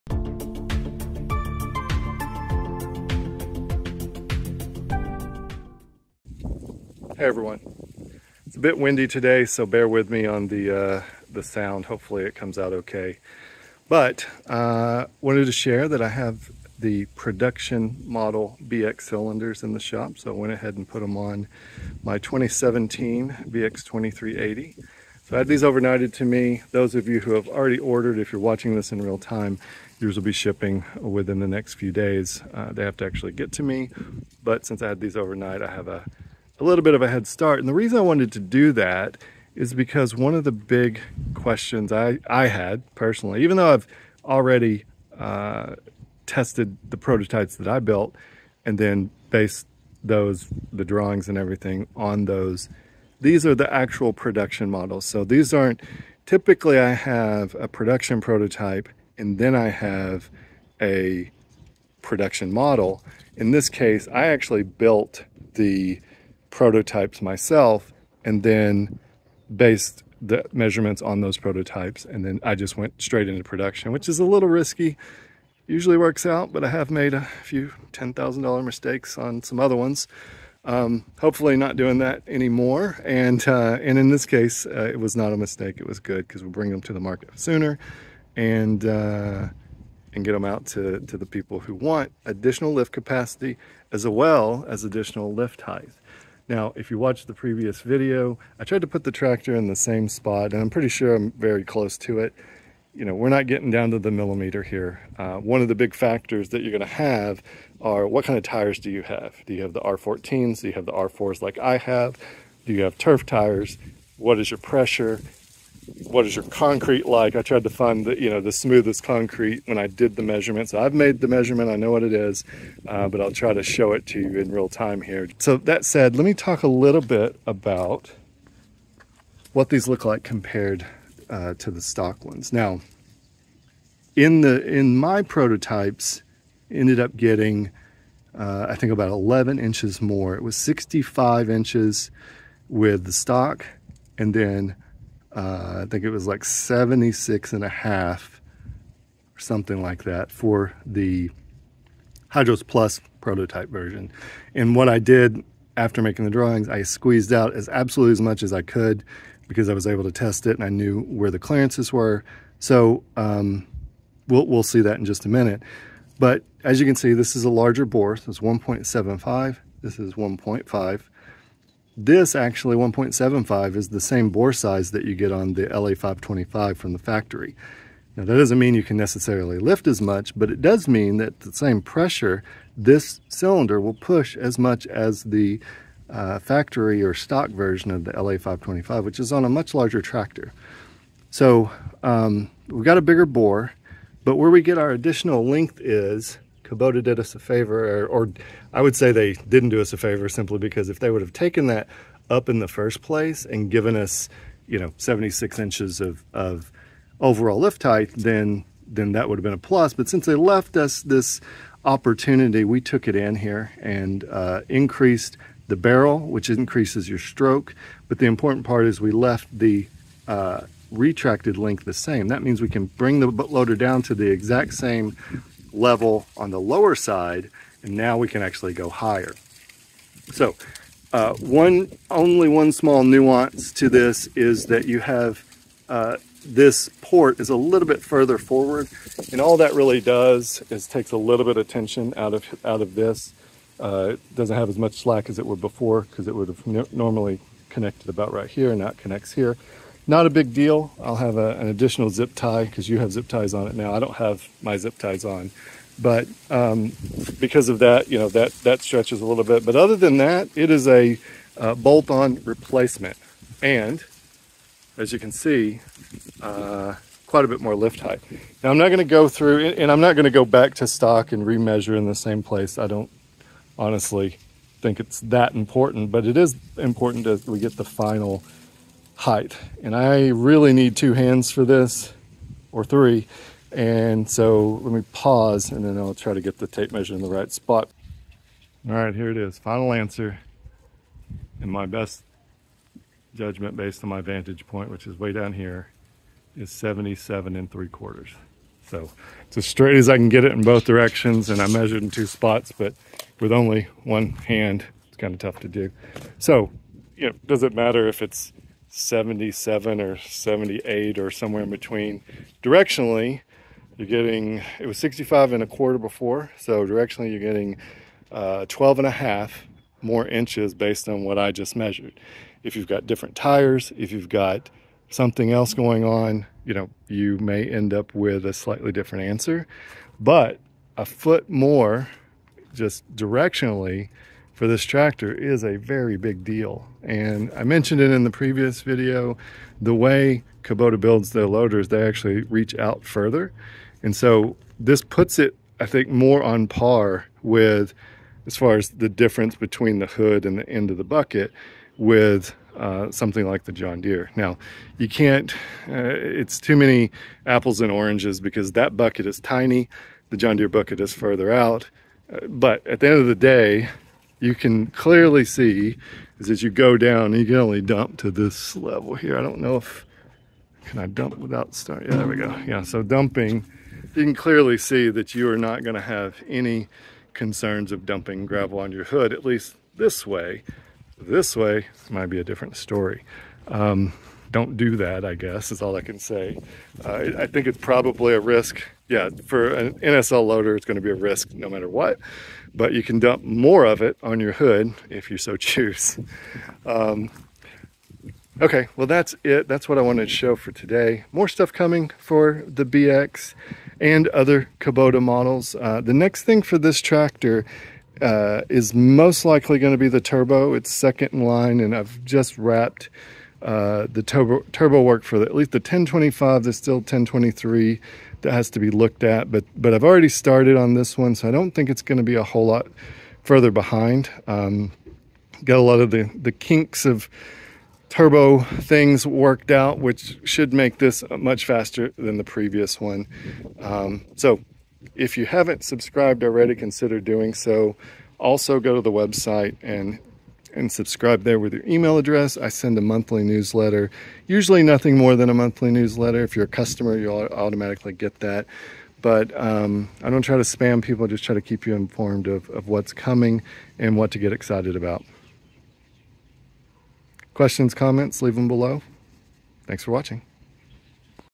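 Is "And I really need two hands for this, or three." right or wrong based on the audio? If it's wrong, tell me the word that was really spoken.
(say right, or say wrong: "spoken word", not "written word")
right.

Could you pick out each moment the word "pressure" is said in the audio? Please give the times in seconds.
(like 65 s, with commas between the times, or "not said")
114 s, 181 s.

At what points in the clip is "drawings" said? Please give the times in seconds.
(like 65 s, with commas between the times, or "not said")
50 s, 156 s.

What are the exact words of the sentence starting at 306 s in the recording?
So, you know, does it matter if it's 77 or 78 or somewhere in between.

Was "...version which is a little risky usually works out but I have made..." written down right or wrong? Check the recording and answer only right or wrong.
wrong.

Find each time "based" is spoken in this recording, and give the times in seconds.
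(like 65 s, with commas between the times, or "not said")
49 s, 69 s, 293 s, 320 s.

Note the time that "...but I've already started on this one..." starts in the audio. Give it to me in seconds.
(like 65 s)
419 s.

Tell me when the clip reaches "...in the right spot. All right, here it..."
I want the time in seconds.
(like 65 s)
287 s.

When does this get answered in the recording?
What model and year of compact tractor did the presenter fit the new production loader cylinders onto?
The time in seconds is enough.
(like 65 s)
22 s.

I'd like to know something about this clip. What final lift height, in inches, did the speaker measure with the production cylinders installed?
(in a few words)
77 3/4.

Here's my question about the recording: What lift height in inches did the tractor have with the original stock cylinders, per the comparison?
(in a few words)
65 1/4.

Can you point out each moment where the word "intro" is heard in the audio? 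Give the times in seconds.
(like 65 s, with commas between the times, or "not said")
not said.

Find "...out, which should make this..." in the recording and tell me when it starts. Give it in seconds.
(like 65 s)
429 s.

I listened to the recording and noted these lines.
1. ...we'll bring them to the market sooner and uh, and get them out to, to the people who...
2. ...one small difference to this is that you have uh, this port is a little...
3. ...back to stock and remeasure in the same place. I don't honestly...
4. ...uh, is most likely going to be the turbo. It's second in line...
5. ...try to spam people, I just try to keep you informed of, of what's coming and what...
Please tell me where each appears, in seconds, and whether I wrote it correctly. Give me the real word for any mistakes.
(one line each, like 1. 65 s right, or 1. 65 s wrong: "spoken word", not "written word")
1. 86 s right
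2. 232 s wrong: "nuance", not "difference"
3. 270 s right
4. 408 s right
5. 450 s right.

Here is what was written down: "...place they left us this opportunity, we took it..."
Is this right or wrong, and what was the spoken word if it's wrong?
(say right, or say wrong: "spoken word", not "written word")
wrong: "since", not "place".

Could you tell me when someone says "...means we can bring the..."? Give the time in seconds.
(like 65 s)
222 s.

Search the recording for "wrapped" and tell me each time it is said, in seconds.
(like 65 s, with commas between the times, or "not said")
412 s.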